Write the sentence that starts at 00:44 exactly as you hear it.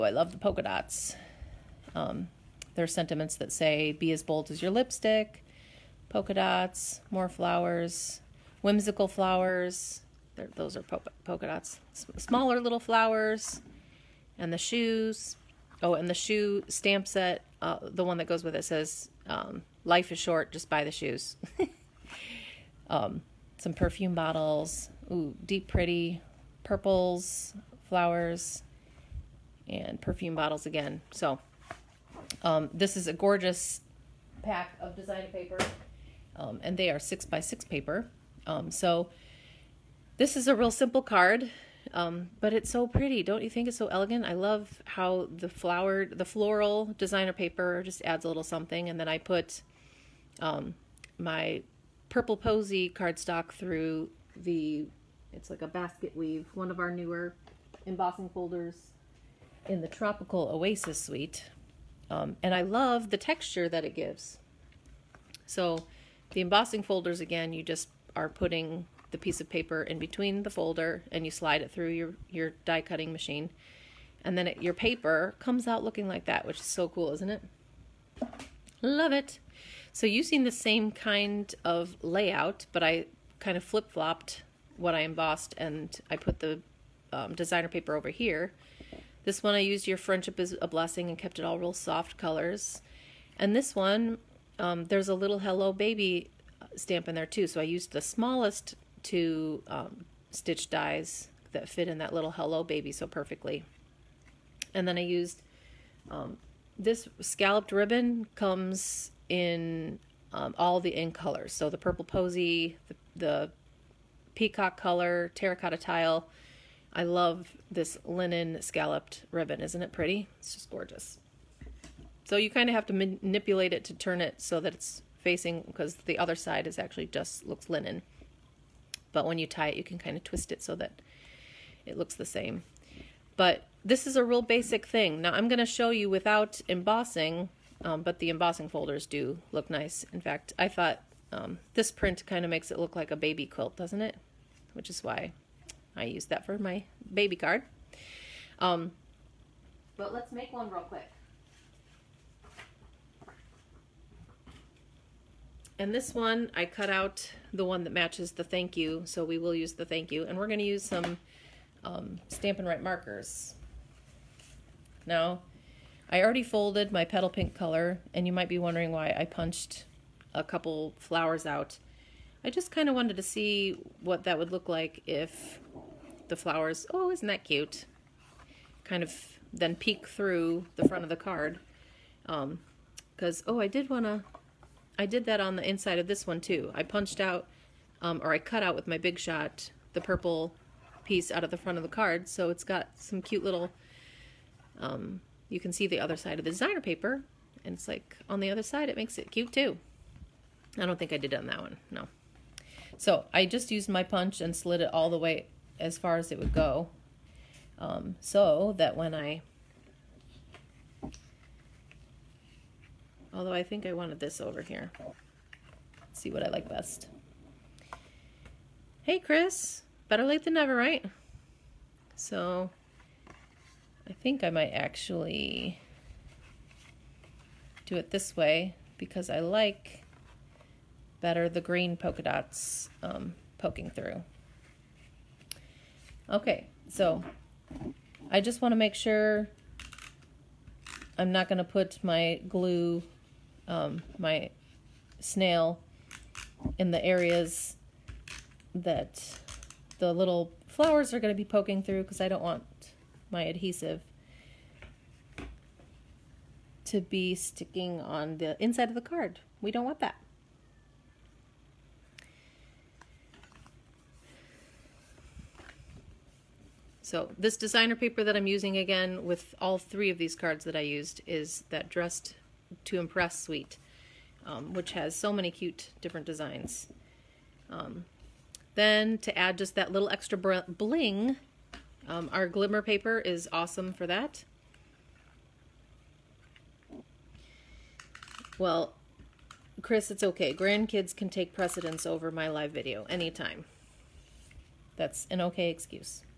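I love how the flowered, the floral designer paper just adds a little something.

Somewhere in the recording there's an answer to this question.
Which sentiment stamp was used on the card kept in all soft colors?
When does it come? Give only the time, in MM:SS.
01:29.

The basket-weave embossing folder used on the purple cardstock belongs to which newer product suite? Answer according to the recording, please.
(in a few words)
Tropical Oasis.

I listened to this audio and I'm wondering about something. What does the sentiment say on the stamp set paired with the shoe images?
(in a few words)
Life is short, just buy the shoes.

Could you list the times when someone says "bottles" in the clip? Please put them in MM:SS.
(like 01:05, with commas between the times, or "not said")
00:24, 00:30.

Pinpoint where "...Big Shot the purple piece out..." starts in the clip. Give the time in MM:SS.
03:08.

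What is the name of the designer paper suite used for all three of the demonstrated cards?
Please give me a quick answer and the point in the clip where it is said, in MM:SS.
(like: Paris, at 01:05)
Dressed to Impress, at 04:31.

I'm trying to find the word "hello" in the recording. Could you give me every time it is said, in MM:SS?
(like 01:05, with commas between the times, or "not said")
01:35, 01:42.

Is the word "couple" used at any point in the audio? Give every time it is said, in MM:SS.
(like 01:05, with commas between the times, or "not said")
02:50.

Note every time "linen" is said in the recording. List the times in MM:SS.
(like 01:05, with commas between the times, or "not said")
01:58, 02:07.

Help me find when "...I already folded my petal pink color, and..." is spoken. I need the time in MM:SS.
02:46.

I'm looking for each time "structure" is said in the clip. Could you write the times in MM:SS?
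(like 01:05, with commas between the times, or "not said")
not said.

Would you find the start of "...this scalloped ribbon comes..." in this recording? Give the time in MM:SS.
01:46.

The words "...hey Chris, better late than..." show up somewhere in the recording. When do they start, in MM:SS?
03:39.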